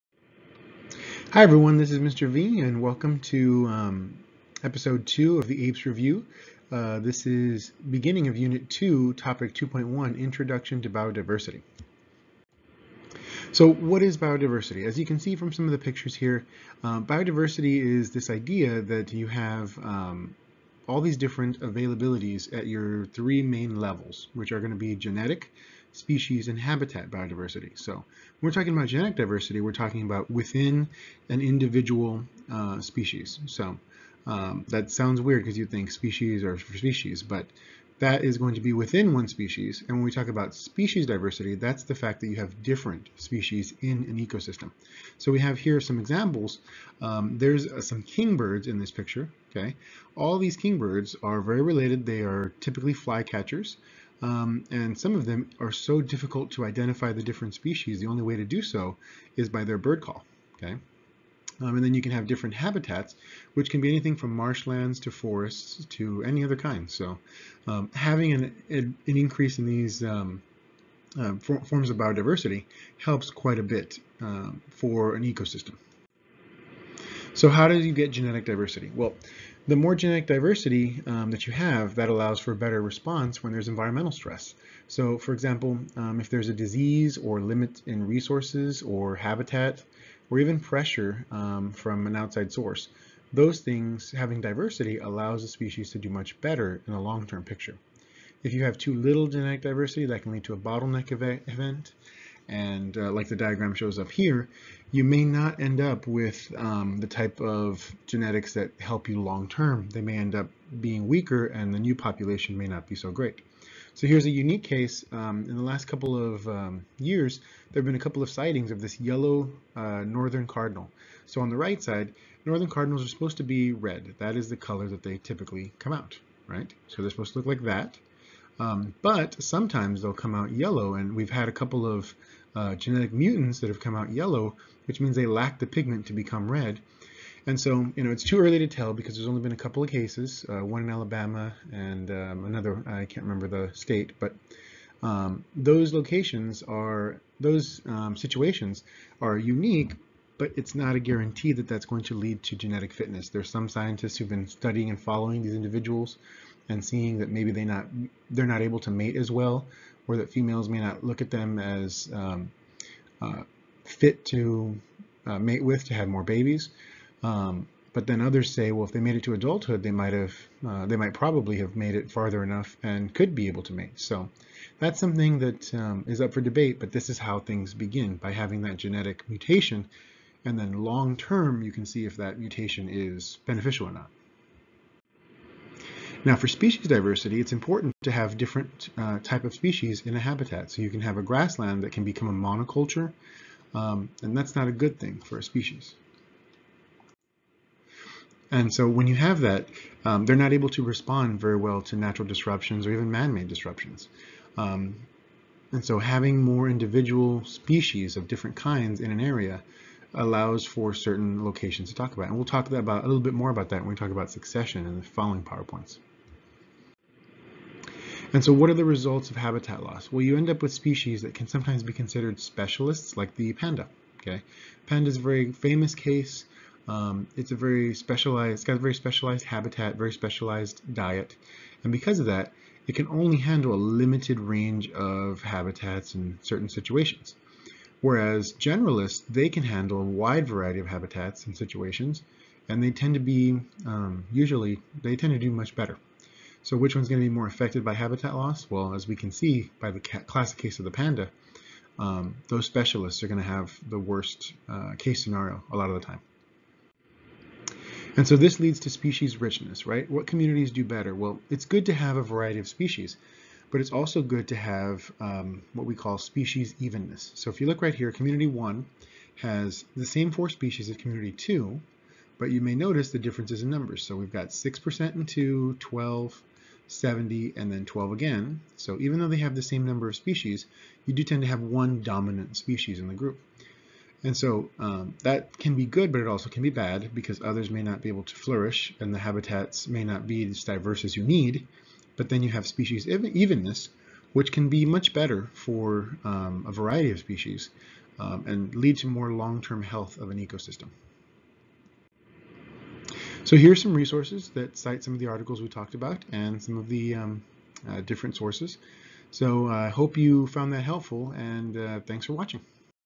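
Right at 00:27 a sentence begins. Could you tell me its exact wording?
So when we're talking about genetic diversity, we're talking about within an individual uh, species.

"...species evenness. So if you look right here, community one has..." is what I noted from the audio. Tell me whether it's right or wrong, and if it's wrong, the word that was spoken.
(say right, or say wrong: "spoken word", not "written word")
right.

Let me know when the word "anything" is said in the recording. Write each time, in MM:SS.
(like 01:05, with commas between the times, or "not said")
01:03.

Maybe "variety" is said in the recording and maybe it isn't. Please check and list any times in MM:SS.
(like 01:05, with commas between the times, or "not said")
04:00, 04:22, 04:56.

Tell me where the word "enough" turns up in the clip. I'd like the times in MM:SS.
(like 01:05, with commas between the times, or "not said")
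02:52.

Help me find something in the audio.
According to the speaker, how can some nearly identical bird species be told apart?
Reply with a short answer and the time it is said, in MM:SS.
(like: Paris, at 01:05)
Their bird call, at 00:59.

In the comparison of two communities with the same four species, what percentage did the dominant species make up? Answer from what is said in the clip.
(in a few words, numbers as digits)
70%.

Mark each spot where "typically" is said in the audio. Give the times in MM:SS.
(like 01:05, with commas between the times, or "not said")
00:52, 02:05.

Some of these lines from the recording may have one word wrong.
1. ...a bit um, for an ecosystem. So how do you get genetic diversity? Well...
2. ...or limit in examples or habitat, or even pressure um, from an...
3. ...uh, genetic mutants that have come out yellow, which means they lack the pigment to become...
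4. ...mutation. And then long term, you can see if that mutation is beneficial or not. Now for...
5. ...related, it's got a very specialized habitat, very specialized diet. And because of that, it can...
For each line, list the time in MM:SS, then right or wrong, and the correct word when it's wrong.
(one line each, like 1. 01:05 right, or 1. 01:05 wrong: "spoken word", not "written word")
1. 01:13 right
2. 01:27 wrong: "resources", not "examples"
3. 02:12 right
4. 02:59 right
5. 03:47 wrong: "specialized", not "related".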